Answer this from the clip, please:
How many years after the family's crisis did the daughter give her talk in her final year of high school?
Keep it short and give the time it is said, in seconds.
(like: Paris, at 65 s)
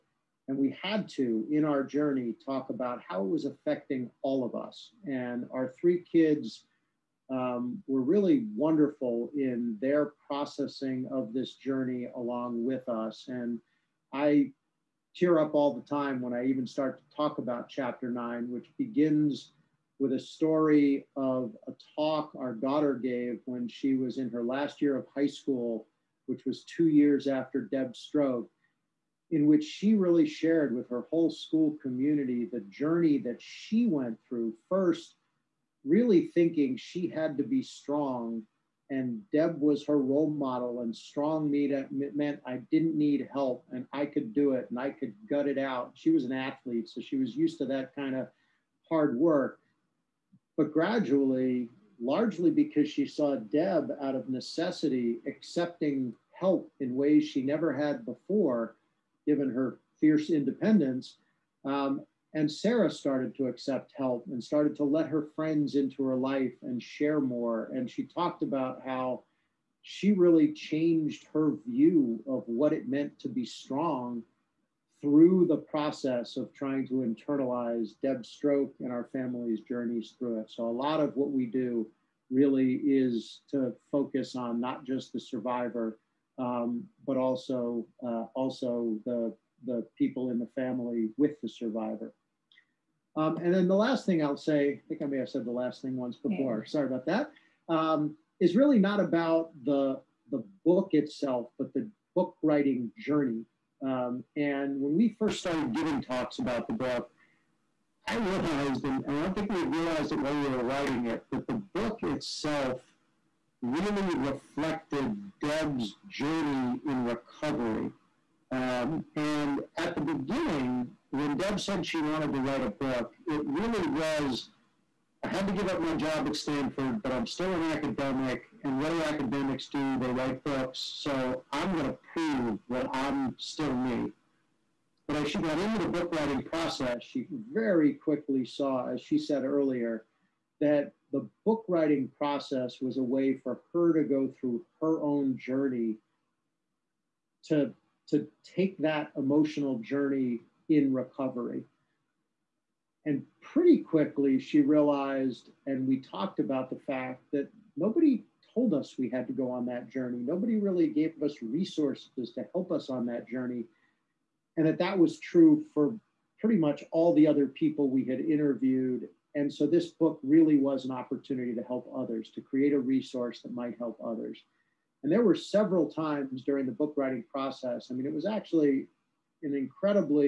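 2, at 26 s.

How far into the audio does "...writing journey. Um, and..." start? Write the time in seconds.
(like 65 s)
102 s.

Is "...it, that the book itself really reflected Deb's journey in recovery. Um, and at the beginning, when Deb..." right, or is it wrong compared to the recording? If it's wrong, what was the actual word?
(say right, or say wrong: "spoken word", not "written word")
right.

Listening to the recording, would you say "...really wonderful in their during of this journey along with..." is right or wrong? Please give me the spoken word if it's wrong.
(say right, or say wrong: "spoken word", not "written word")
wrong: "processing", not "during".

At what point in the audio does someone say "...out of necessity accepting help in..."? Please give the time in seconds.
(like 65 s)
54 s.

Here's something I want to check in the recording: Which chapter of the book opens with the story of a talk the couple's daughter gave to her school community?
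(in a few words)
Chapter 9.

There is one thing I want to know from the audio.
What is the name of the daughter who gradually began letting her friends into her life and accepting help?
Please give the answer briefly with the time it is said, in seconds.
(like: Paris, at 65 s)
Sarah, at 62 s.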